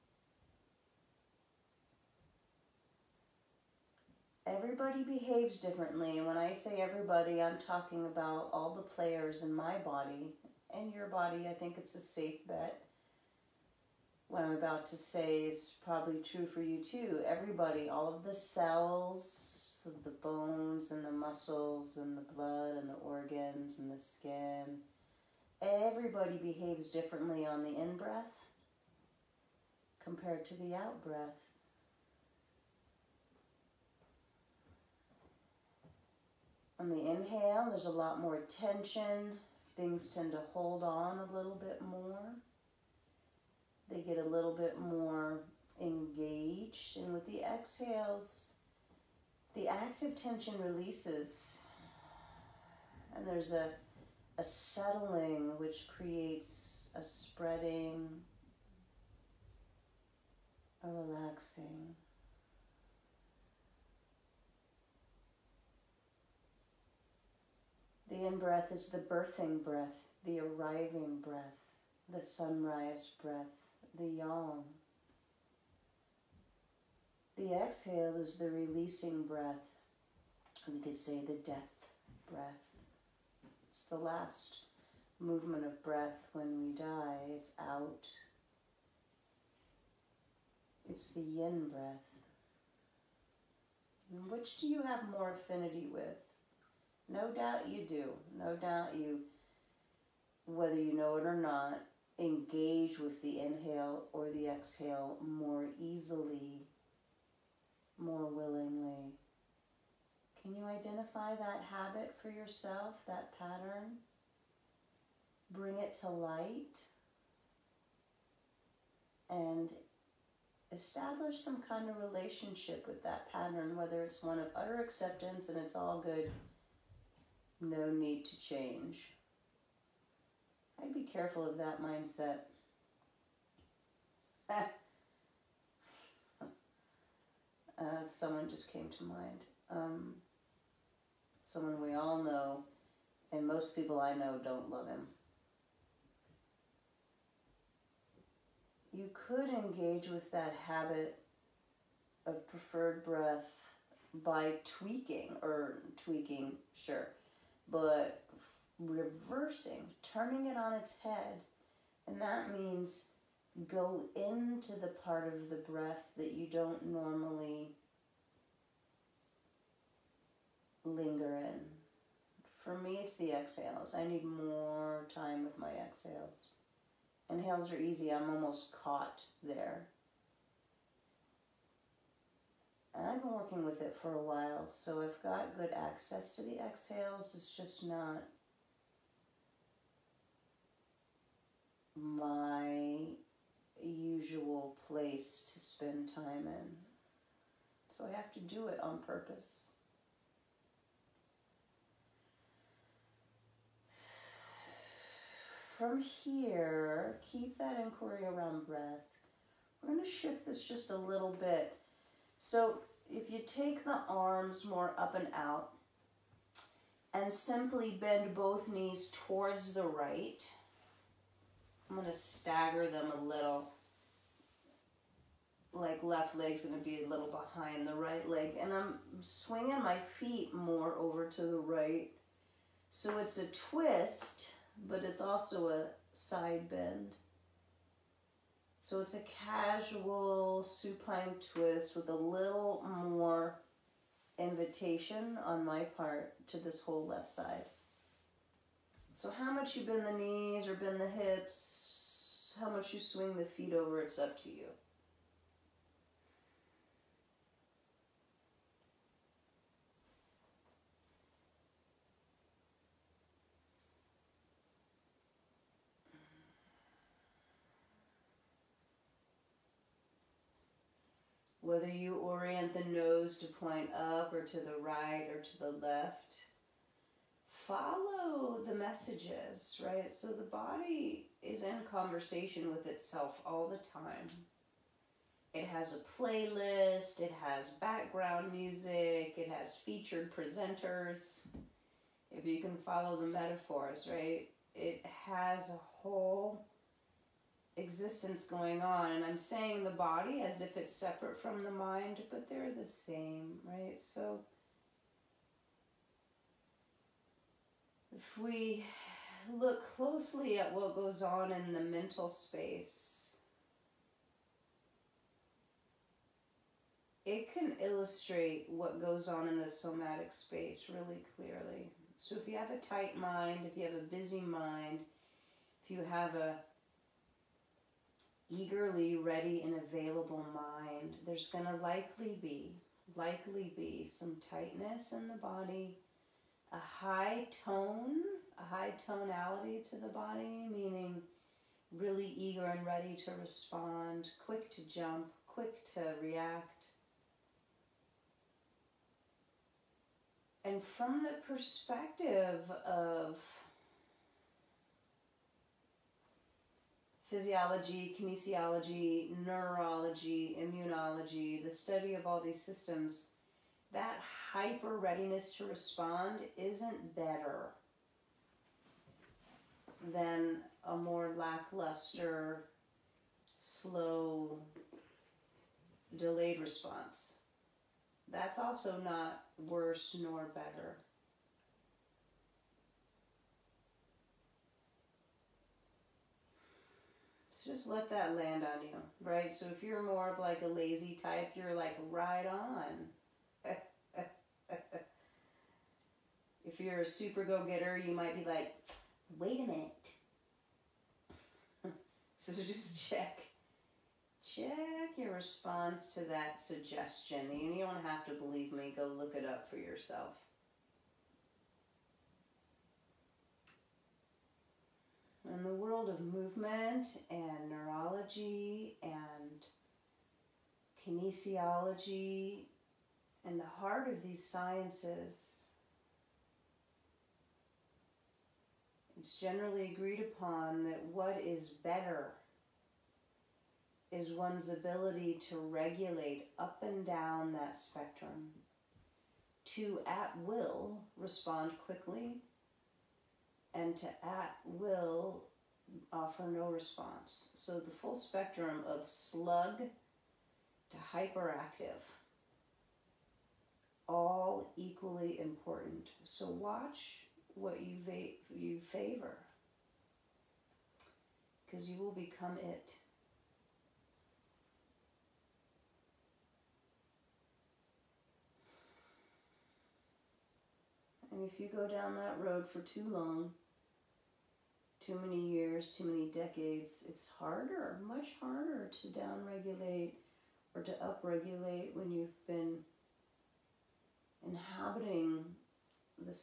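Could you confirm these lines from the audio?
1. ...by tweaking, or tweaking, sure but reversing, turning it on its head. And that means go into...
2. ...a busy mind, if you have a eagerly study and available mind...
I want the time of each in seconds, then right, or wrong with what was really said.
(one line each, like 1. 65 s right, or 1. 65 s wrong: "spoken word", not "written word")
1. 154 s right
2. 323 s wrong: "ready", not "study".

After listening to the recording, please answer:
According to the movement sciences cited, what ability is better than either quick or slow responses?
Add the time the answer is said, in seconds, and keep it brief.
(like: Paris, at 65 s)
Regulate up and down, at 435 s.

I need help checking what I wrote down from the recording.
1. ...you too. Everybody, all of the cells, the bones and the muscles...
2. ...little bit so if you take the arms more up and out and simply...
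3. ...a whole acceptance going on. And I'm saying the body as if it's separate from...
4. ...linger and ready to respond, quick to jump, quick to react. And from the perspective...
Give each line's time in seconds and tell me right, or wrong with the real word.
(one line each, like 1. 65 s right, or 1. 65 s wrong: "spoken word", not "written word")
1. 16 s right
2. 210 s right
3. 295 s wrong: "existence", not "acceptance"
4. 342 s wrong: "eager", not "linger".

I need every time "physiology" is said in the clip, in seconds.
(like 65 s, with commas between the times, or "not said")
357 s.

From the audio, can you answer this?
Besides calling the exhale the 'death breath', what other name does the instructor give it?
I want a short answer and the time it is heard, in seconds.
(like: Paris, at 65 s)
Releasing breath, at 78 s.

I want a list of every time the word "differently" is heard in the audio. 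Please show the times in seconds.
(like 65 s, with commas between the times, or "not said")
5 s, 26 s.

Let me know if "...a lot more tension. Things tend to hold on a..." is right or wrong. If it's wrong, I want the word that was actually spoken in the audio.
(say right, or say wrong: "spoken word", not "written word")
right.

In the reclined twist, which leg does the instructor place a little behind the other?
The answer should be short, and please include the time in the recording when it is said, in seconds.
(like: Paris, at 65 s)
Left leg, at 226 s.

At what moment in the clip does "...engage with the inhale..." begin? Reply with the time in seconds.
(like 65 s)
102 s.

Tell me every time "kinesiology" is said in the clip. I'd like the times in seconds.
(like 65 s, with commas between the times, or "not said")
358 s, 421 s.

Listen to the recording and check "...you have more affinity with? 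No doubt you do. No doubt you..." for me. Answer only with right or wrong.
right.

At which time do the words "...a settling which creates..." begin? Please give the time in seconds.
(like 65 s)
54 s.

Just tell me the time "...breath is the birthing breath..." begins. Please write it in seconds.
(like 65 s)
68 s.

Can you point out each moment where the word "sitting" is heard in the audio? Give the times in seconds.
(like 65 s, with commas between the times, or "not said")
not said.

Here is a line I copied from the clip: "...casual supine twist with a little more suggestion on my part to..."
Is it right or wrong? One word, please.
wrong.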